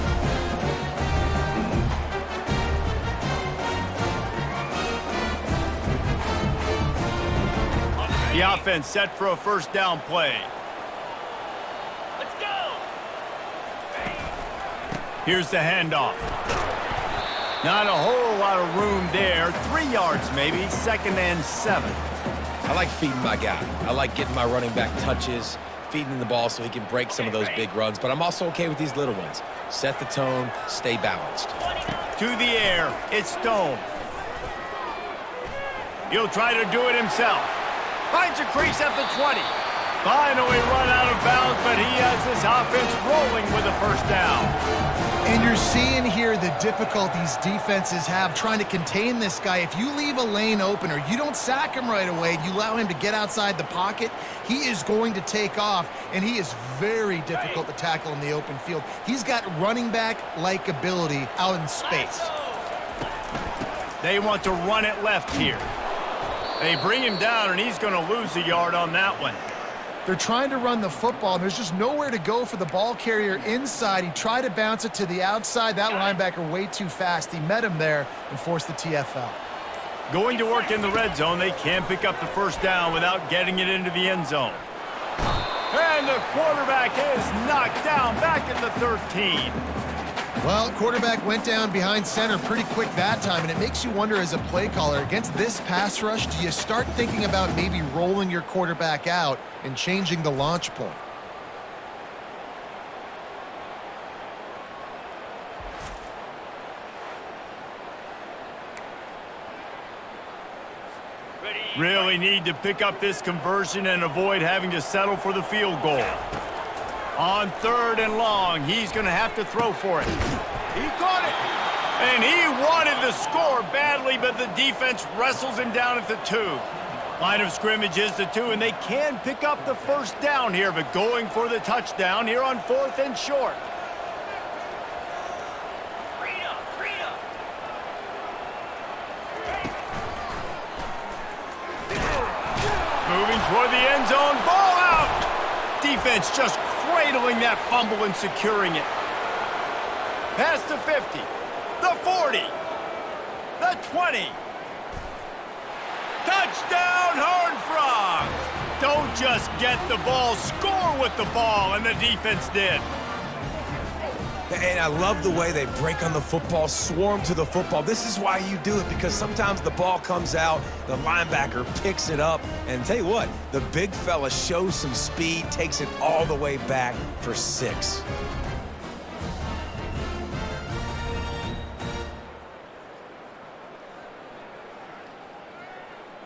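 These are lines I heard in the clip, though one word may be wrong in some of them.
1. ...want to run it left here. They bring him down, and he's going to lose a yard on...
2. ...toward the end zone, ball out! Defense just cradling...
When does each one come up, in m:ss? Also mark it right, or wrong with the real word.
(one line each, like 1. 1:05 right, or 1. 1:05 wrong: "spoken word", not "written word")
1. 1:04 right
2. 2:23 right.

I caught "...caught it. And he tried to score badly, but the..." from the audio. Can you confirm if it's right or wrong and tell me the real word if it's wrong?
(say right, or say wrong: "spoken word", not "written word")
wrong: "wanted", not "tried".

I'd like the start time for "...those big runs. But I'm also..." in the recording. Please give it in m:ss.
0:27.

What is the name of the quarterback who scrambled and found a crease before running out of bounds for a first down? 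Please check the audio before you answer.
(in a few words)
Stone.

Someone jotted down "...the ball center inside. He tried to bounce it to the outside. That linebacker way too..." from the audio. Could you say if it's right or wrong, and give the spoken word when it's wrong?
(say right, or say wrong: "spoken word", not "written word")
wrong: "carrier", not "center".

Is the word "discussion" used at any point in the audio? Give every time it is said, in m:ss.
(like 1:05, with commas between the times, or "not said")
not said.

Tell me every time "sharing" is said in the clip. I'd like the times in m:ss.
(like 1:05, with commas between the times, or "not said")
not said.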